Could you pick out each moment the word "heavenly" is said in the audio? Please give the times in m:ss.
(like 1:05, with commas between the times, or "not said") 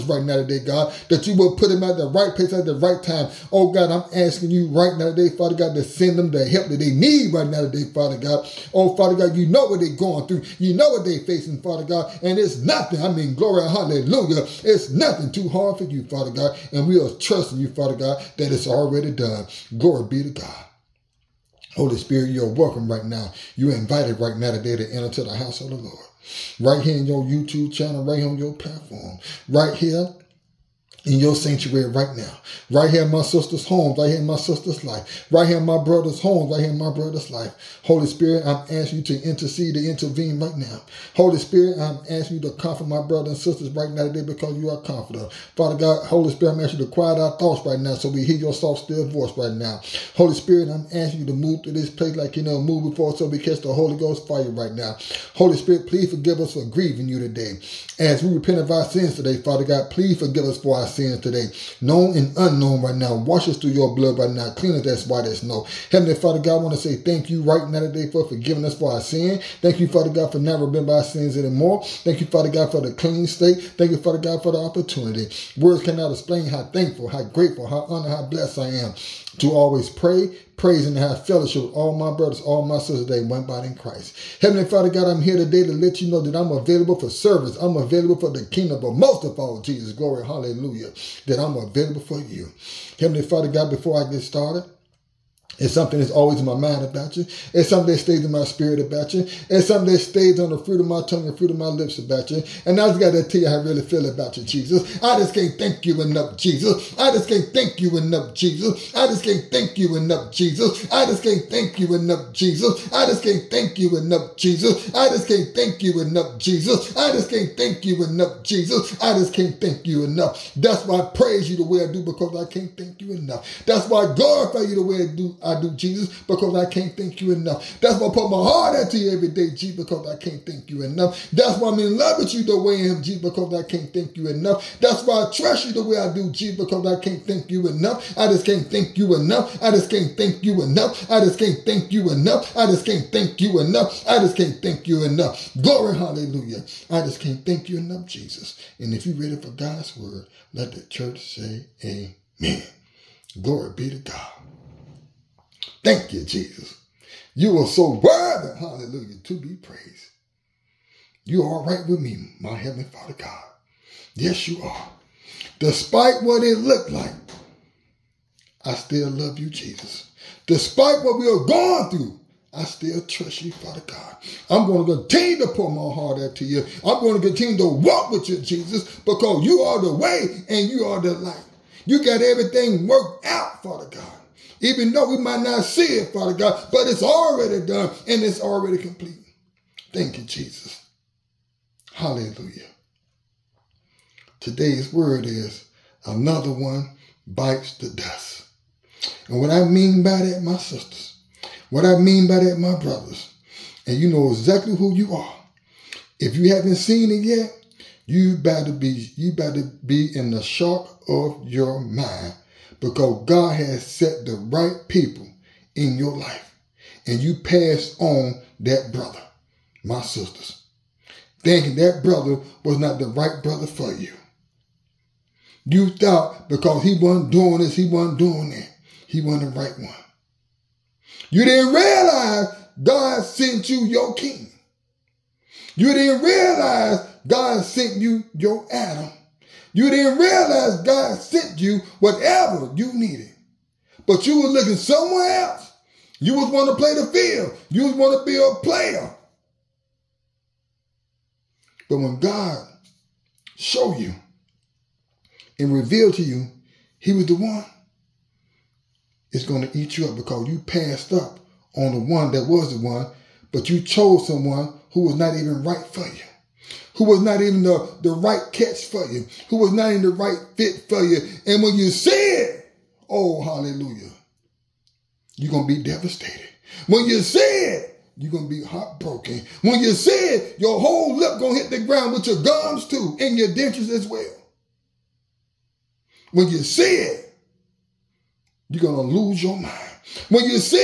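1:05, 1:24, 1:32, 2:42.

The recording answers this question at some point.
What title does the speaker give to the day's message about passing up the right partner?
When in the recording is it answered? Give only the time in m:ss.
3:16.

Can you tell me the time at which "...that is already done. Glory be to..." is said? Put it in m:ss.
0:18.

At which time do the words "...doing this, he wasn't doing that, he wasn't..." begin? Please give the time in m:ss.
3:47.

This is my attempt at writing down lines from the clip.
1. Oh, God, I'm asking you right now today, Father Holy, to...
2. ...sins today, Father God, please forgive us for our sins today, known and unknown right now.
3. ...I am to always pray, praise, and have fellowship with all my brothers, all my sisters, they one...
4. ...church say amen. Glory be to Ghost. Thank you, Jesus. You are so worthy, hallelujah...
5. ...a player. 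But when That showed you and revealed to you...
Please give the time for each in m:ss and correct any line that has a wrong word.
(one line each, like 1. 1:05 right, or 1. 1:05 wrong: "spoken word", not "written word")
1. 0:03 wrong: "God", not "Holy"
2. 0:58 right
3. 1:18 right
4. 2:30 wrong: "God", not "Ghost"
5. 4:08 wrong: "God", not "That".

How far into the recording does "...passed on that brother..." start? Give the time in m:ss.
3:37.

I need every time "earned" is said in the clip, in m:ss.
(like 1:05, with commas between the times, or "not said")
not said.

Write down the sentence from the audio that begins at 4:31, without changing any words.
And when you see it, oh, hallelujah, you're going to be devastated.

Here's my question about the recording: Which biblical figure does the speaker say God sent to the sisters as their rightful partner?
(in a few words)
Adam.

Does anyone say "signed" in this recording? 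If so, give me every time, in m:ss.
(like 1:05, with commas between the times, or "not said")
not said.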